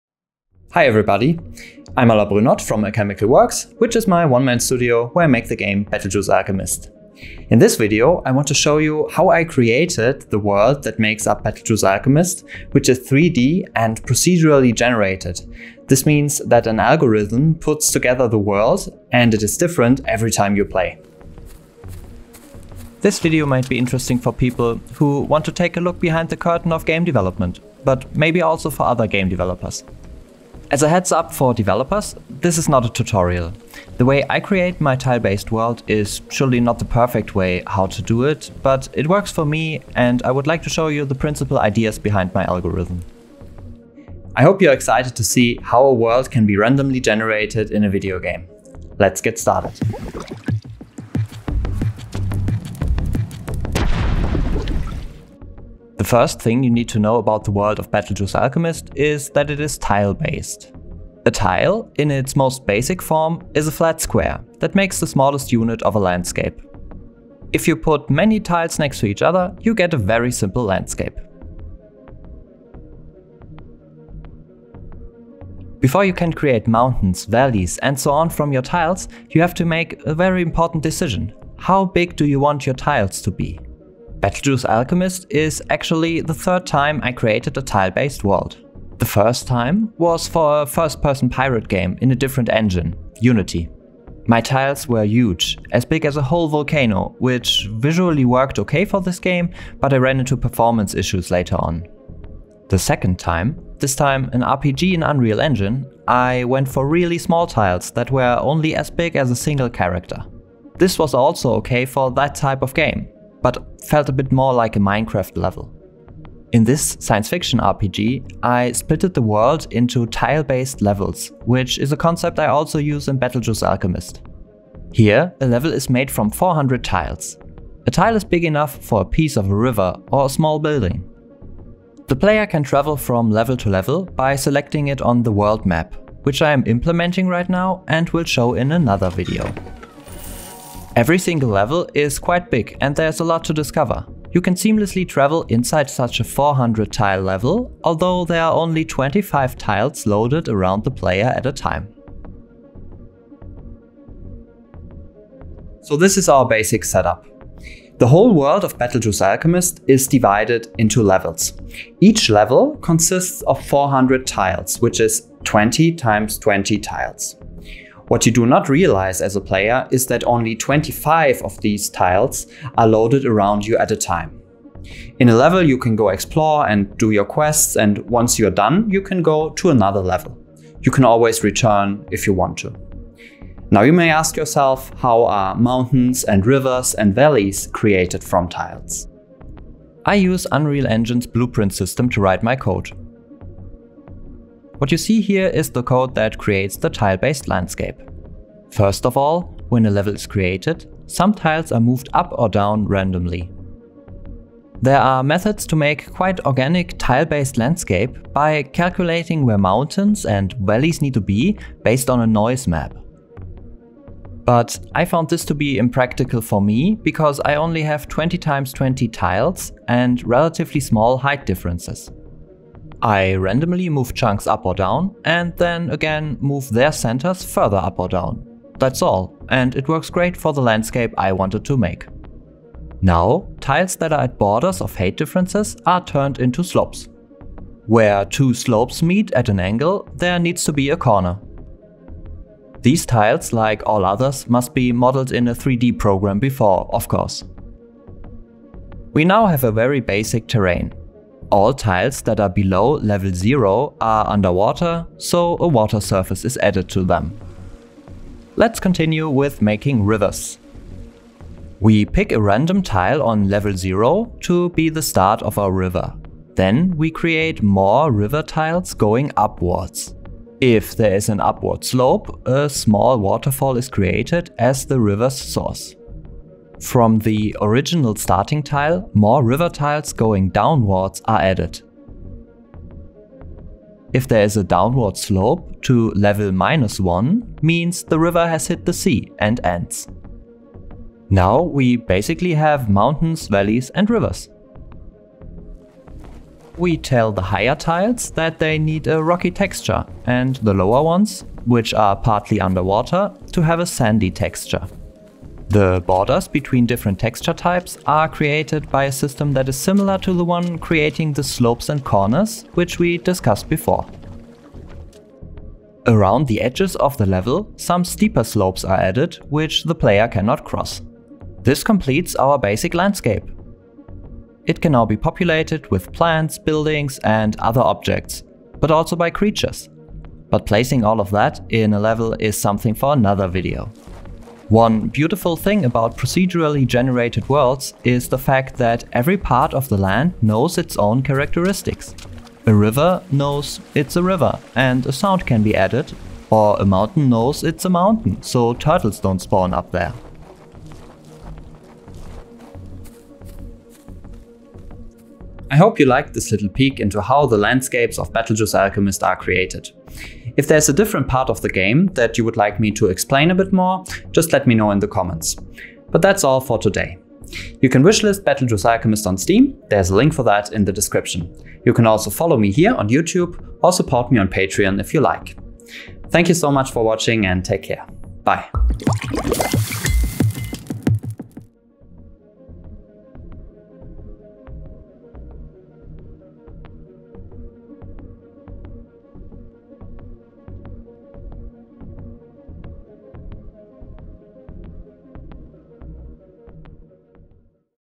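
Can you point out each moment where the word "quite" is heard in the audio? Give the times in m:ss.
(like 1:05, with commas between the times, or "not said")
2:22, 3:26.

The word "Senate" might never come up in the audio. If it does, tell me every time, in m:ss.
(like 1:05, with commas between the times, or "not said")
not said.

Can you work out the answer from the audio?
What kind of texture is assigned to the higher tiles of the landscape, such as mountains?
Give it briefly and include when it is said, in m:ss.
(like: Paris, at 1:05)
rocky, at 4:59.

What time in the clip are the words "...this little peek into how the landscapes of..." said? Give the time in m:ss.
5:56.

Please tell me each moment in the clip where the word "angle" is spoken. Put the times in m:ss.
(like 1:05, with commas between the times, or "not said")
3:59.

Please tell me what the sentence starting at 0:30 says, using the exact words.
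As a heads up for developers, this is not a tutorial.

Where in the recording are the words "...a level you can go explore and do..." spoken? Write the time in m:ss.
2:55.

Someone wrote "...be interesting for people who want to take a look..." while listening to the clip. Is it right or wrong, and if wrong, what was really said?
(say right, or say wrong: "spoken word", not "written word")
right.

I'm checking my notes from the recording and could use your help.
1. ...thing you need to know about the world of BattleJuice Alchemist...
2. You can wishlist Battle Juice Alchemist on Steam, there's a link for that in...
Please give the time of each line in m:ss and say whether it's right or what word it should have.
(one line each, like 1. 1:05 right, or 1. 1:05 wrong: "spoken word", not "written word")
1. 0:56 right
2. 6:07 right.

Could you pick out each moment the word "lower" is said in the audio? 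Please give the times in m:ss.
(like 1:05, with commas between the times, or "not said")
5:00.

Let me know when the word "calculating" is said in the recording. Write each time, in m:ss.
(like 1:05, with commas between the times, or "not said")
3:28.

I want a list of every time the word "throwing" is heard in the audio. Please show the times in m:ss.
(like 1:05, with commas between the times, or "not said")
not said.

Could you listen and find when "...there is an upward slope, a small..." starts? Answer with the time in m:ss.
4:30.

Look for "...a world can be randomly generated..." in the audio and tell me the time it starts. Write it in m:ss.
0:45.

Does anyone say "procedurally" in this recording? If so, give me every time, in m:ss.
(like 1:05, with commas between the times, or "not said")
0:14, 5:36.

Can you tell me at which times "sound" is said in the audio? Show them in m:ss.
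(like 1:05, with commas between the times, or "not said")
5:45.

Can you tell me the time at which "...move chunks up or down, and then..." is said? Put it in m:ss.
3:43.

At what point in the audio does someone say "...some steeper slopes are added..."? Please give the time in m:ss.
5:17.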